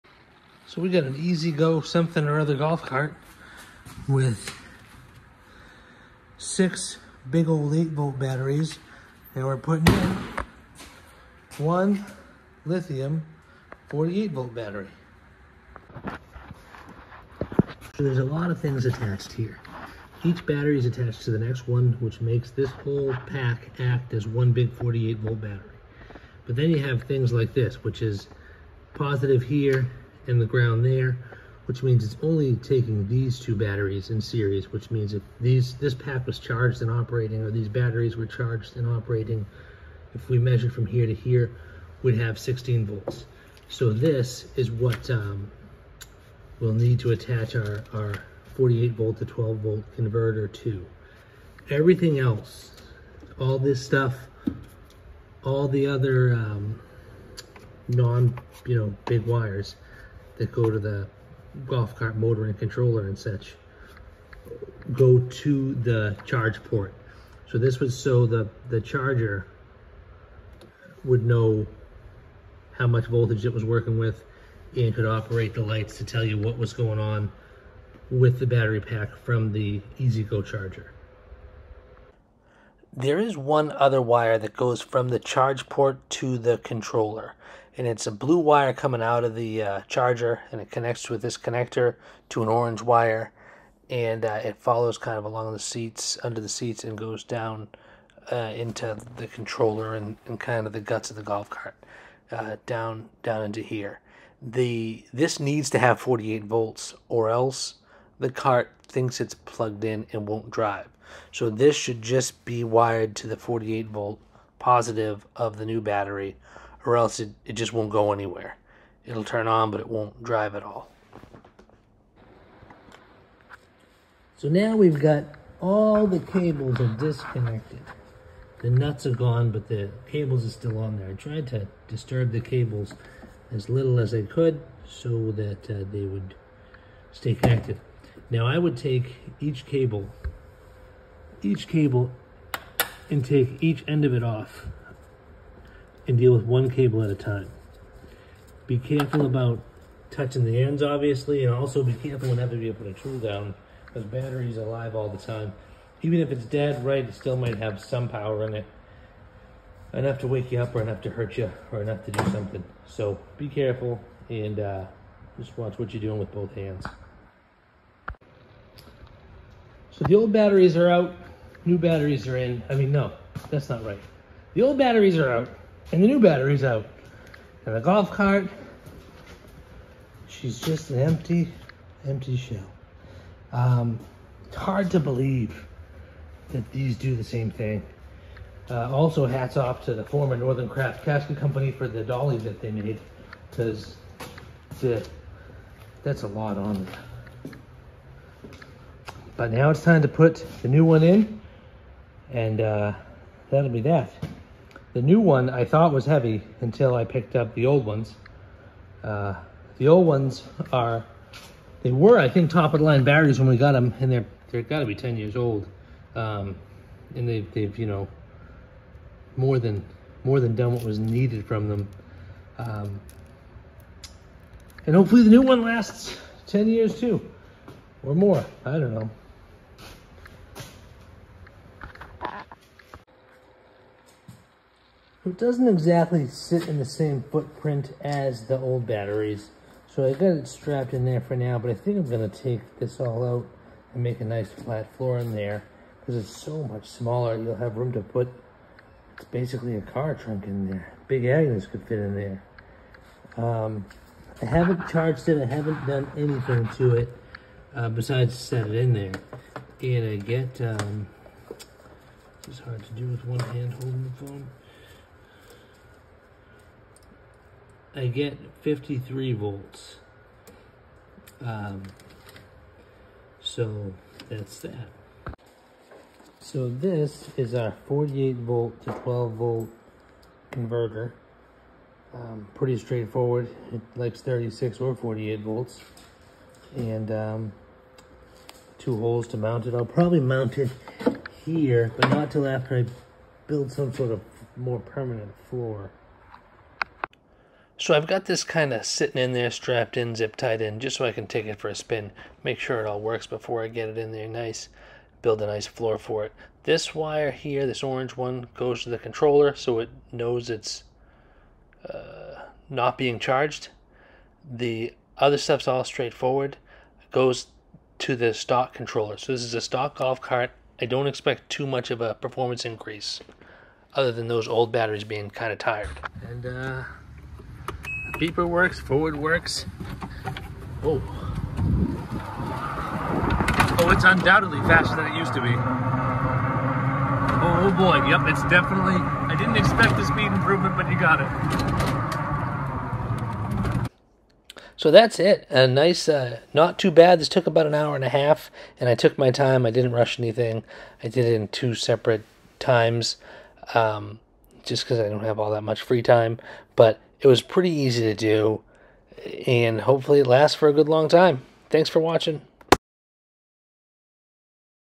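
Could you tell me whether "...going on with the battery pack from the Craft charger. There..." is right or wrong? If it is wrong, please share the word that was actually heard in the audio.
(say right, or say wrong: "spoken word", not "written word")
wrong: "EZGO", not "Craft".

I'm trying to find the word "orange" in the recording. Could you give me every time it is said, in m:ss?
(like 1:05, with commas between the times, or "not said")
1:32, 5:07.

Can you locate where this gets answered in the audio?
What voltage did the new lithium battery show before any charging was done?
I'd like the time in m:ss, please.
4:28.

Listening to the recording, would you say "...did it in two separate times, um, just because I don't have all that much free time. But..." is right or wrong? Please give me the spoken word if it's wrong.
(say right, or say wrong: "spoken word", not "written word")
right.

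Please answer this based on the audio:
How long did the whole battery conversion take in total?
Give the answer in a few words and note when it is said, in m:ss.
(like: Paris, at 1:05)
An hour and a half, at 5:47.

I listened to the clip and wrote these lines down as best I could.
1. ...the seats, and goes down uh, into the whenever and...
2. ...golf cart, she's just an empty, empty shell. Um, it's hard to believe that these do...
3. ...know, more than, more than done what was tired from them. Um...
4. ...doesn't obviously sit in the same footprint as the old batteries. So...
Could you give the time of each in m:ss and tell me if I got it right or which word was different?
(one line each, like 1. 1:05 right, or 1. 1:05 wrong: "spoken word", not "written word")
1. 1:36 wrong: "controller", not "whenever"
2. 2:57 right
3. 3:37 wrong: "needed", not "tired"
4. 3:55 wrong: "exactly", not "obviously".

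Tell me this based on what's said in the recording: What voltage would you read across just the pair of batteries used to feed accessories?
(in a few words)
16 volts.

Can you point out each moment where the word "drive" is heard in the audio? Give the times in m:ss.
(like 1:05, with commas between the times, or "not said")
1:50, 2:00.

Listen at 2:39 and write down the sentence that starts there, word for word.
Enough to wake you up or enough to hurt you or enough to do something.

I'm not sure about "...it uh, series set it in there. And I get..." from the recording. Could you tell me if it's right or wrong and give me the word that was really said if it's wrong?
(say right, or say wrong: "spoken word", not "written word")
wrong: "besides", not "series".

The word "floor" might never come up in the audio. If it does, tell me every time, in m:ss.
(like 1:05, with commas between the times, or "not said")
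4:04, 4:55, 5:05.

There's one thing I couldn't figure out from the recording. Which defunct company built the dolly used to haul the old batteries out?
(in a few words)
Northern Craft Casket Company.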